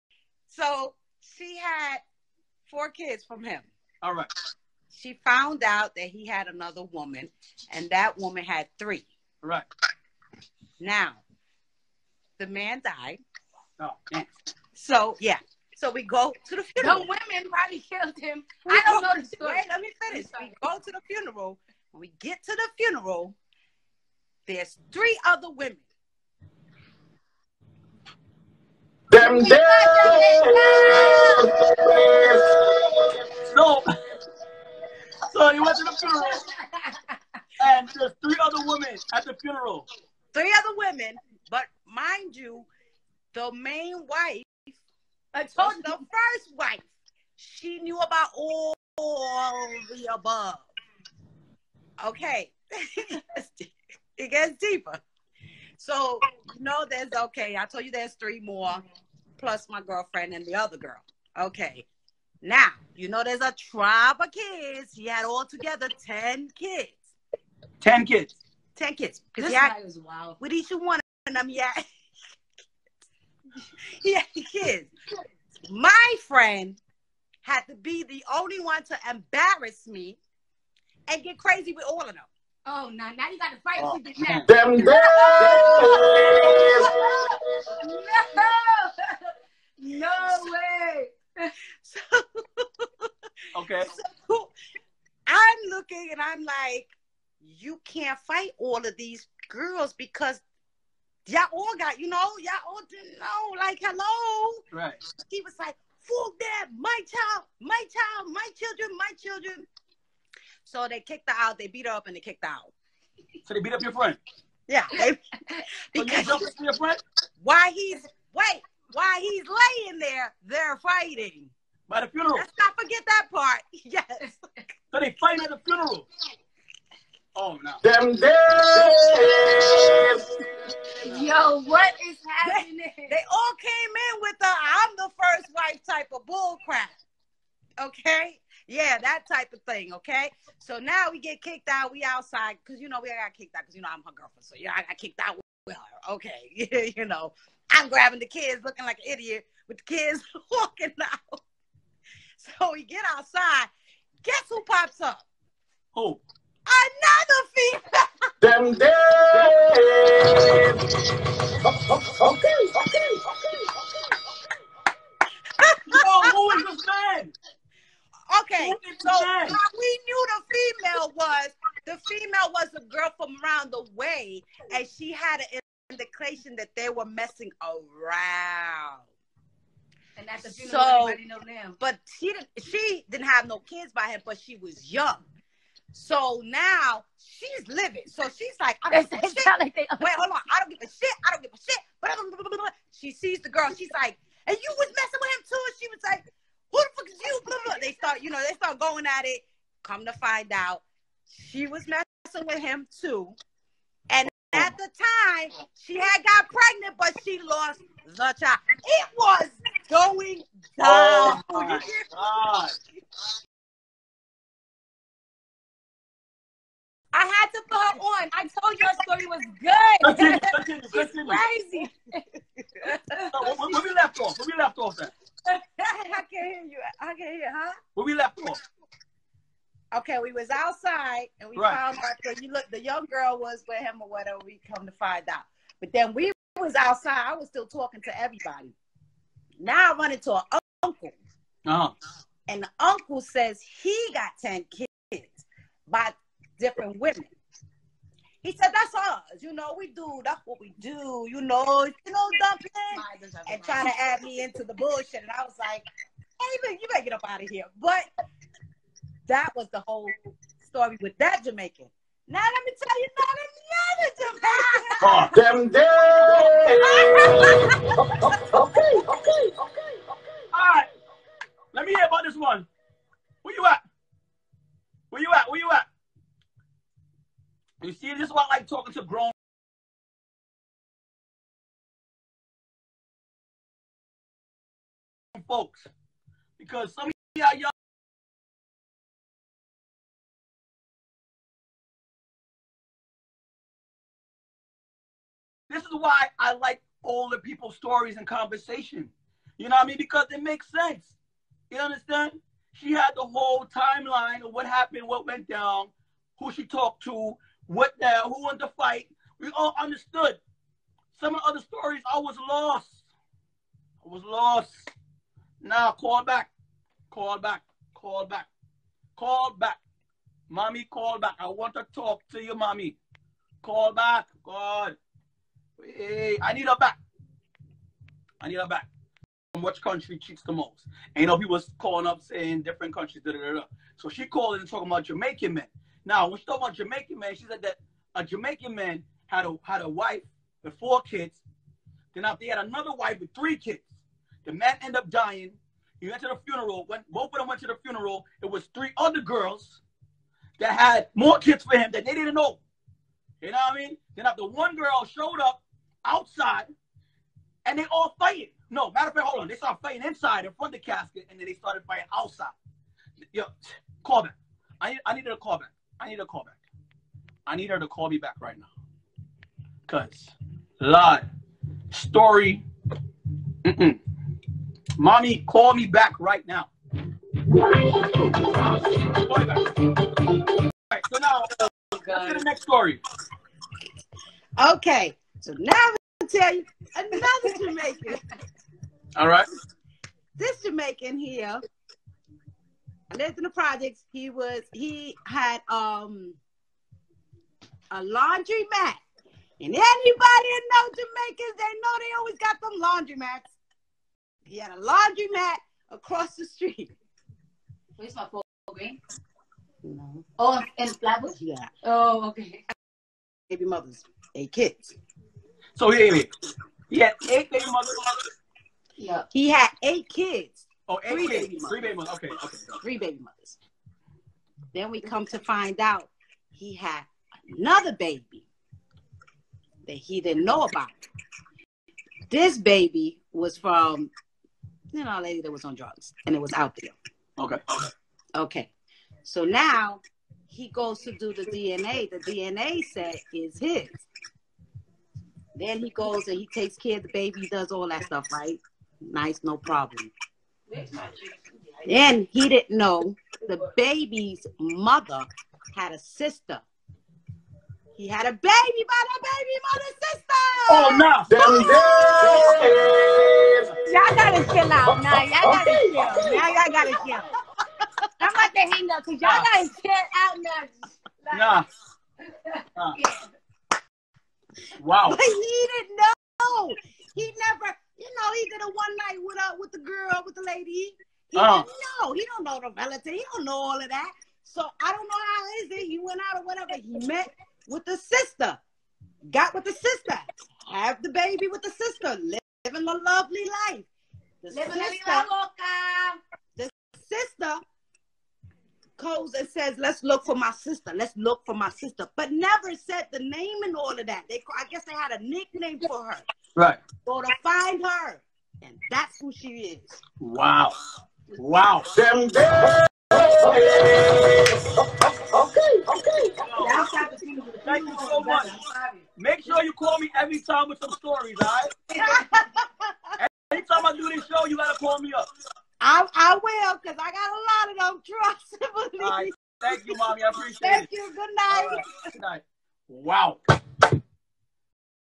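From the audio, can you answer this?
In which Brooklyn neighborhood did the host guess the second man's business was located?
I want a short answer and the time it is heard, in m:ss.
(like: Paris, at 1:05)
Flatbush, at 6:50.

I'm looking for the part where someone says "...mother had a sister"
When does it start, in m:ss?
7:34.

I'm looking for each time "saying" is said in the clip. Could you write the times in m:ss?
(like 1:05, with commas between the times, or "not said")
5:32.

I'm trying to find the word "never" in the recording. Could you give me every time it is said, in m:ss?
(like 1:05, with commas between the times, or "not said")
7:57, 8:22.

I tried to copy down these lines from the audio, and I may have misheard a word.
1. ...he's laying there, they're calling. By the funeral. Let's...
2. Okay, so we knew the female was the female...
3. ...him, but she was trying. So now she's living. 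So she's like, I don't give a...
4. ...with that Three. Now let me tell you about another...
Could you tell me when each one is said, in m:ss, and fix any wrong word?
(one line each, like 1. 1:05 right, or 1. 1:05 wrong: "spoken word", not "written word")
1. 1:59 wrong: "fighting", not "calling"
2. 2:48 right
3. 3:04 wrong: "young", not "trying"
4. 4:21 wrong: "Jamaican", not "Three".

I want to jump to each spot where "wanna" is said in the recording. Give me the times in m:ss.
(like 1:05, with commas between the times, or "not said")
not said.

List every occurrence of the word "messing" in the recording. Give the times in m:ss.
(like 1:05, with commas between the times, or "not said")
2:57, 3:14, 3:21.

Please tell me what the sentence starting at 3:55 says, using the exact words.
But then we was outside, I was still talking to everybody.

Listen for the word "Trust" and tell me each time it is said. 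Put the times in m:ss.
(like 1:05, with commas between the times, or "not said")
8:48.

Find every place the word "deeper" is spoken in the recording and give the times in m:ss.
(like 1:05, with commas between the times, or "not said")
0:54.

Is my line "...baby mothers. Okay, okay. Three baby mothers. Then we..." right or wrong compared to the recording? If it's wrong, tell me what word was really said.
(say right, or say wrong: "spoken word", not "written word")
right.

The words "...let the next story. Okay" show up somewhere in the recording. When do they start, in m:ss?
6:22.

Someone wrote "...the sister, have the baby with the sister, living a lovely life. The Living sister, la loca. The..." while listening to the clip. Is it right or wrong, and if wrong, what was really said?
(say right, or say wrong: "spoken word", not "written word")
right.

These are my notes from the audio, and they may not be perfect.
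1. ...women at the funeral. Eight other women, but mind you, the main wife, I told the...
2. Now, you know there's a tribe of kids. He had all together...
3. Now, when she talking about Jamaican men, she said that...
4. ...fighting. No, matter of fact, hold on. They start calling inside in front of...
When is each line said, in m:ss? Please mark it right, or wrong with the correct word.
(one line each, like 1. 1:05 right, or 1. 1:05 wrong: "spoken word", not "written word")
1. 0:38 wrong: "Three", not "Eight"
2. 1:02 right
3. 5:36 right
4. 5:58 wrong: "fighting", not "calling".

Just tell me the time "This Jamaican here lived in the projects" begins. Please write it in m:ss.
6:30.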